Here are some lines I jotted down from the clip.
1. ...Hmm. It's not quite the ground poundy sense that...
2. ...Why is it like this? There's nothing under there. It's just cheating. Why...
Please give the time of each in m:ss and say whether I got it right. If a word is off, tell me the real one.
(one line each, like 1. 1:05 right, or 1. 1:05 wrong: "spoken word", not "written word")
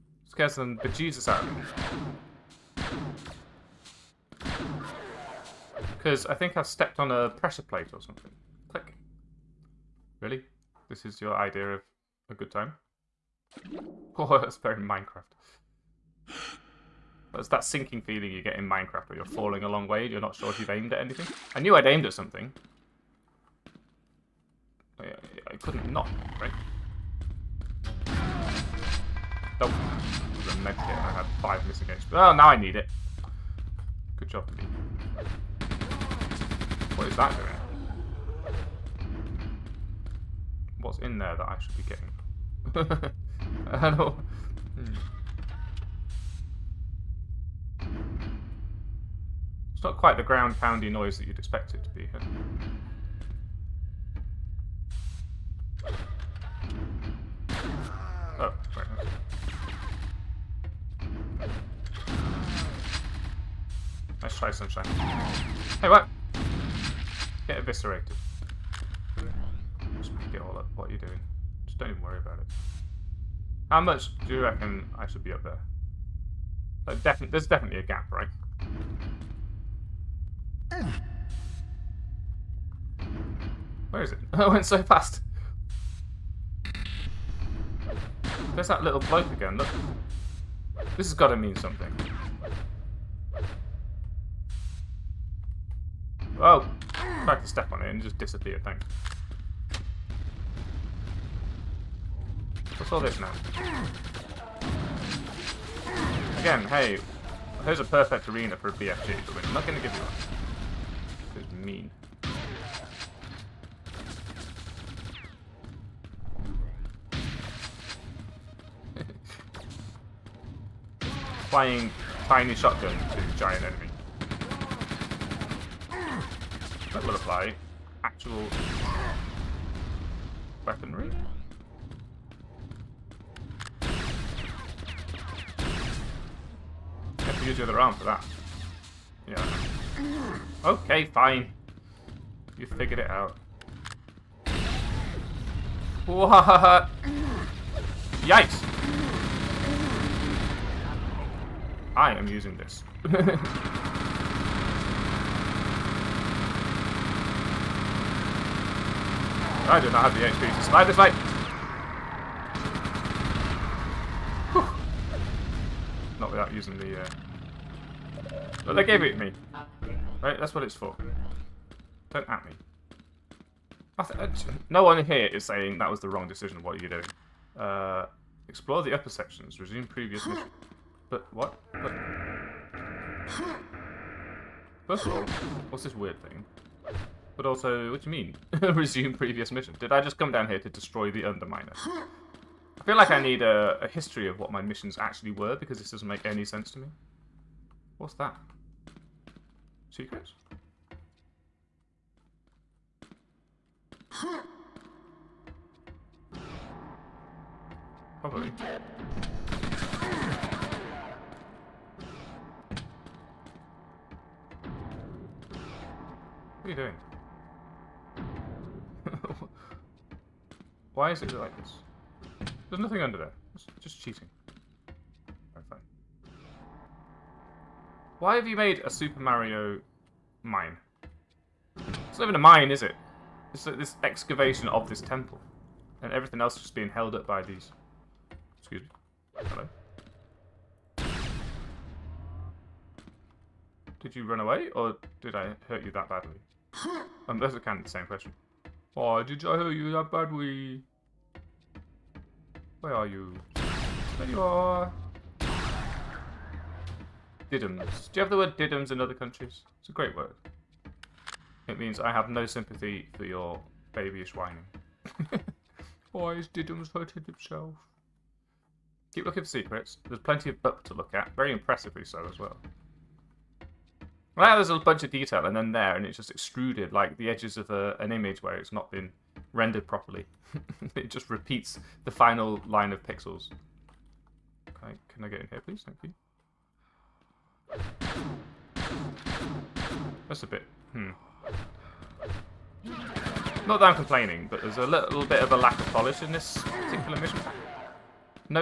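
1. 0:44 wrong: "noise", not "sense"
2. 3:40 right.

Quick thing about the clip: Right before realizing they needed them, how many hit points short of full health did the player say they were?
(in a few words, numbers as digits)
5.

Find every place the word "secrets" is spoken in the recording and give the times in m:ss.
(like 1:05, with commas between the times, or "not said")
3:19, 4:29.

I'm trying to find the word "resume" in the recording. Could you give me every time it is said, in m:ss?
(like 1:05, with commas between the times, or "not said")
2:59, 3:08.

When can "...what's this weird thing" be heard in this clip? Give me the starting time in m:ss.
3:05.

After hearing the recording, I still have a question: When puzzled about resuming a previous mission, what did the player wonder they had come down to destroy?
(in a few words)
the Underminer.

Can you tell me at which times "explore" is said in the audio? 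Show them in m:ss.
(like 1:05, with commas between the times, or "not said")
2:58.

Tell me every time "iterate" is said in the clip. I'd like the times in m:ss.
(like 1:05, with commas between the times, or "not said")
not said.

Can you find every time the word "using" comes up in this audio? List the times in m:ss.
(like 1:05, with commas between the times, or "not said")
2:32, 2:46.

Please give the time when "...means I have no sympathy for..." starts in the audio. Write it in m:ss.
4:21.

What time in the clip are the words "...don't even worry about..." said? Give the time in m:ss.
1:11.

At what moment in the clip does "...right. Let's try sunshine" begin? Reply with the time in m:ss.
1:01.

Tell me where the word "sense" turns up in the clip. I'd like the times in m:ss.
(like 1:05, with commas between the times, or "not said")
3:16.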